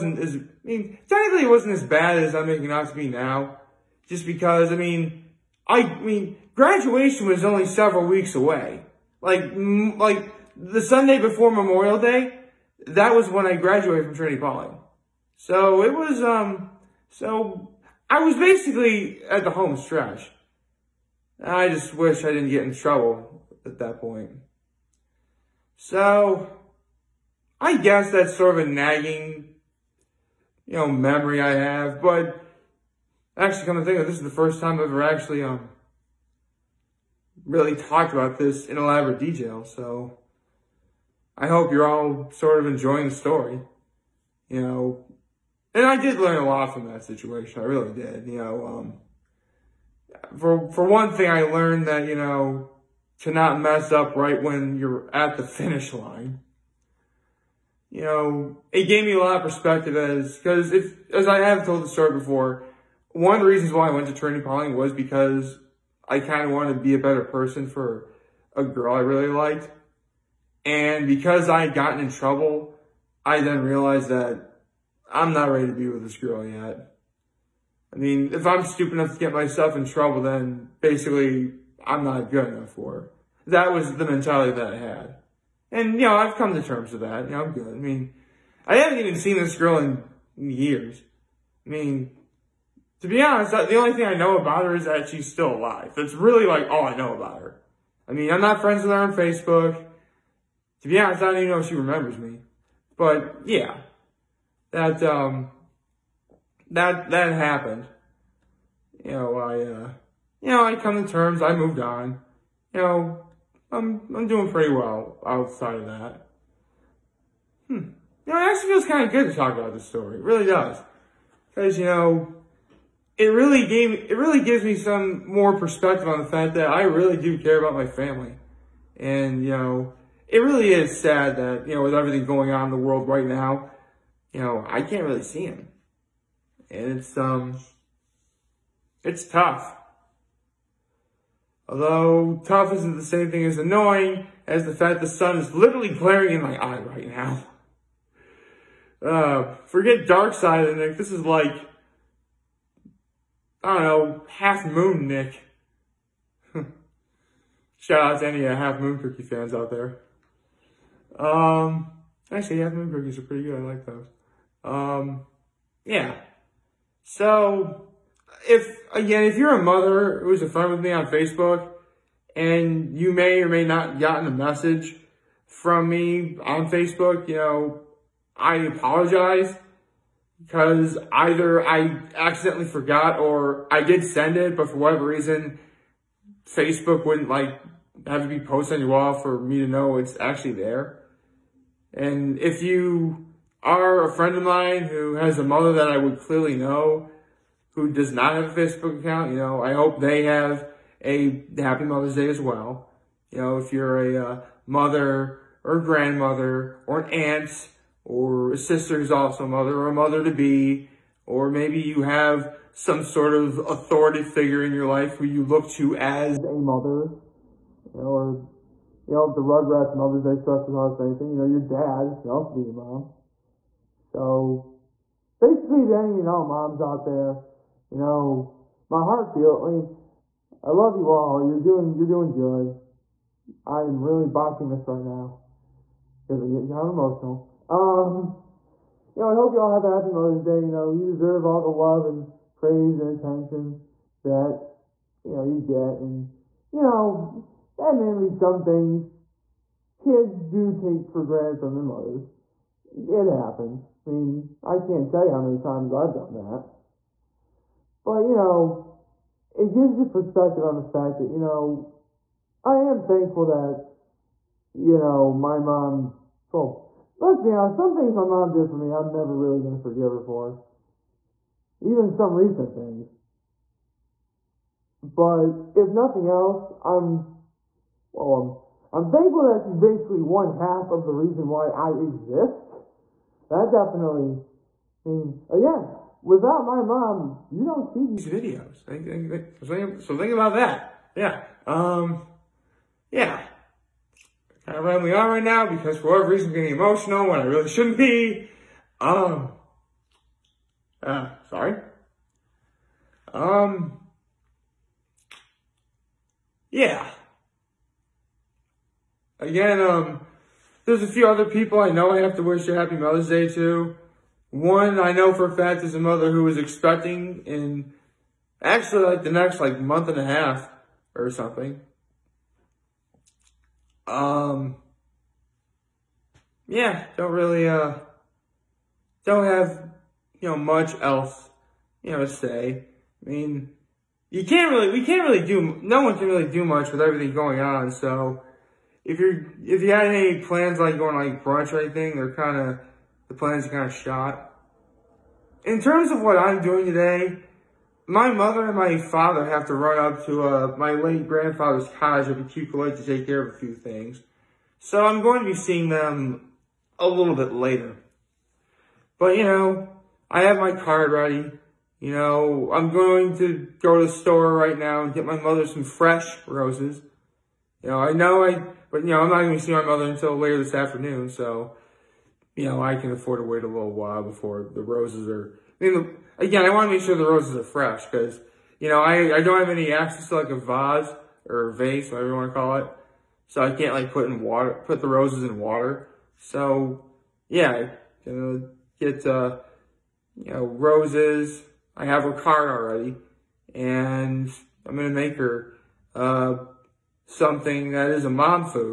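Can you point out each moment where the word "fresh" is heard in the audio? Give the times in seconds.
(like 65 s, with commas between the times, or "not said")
365 s, 377 s.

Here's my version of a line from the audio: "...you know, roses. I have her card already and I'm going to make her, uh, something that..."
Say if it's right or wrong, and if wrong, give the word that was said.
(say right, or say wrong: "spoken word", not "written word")
right.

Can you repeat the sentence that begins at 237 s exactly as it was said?
Um, you know, I hope y'all have a happy Mother's Day.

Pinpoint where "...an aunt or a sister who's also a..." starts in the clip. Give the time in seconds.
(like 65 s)
207 s.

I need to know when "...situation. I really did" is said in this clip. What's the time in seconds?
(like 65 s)
47 s.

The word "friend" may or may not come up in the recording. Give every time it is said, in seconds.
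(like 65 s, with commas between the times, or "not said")
98 s, 170 s, 194 s.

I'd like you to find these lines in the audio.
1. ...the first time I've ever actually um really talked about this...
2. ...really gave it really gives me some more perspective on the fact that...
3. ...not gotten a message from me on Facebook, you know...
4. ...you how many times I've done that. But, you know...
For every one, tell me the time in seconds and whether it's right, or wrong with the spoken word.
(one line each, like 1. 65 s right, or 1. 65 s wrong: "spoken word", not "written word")
1. 34 s right
2. 123 s right
3. 173 s right
4. 255 s right.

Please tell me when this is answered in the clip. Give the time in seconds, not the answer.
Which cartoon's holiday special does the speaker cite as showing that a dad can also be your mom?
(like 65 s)
219 s.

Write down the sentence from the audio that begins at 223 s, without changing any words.
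So, basically to any, you know, moms out there, you know, my heart feel, I mean, I love you all.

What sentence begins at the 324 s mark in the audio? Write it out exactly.
Um, yeah, don't really, uh, don't have, you know, much else, you know, to say.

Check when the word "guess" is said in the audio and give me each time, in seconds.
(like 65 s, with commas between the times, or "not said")
27 s.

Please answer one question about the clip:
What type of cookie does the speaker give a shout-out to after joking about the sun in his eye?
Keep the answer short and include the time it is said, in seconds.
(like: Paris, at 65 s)
Half moon cookies, at 158 s.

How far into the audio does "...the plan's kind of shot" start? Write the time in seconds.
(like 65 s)
343 s.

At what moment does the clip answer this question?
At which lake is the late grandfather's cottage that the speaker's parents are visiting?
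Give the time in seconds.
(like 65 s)
352 s.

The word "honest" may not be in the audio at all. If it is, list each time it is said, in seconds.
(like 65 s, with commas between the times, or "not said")
93 s, 100 s, 267 s.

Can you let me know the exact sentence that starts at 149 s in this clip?
Uh, forget dark side of Nick.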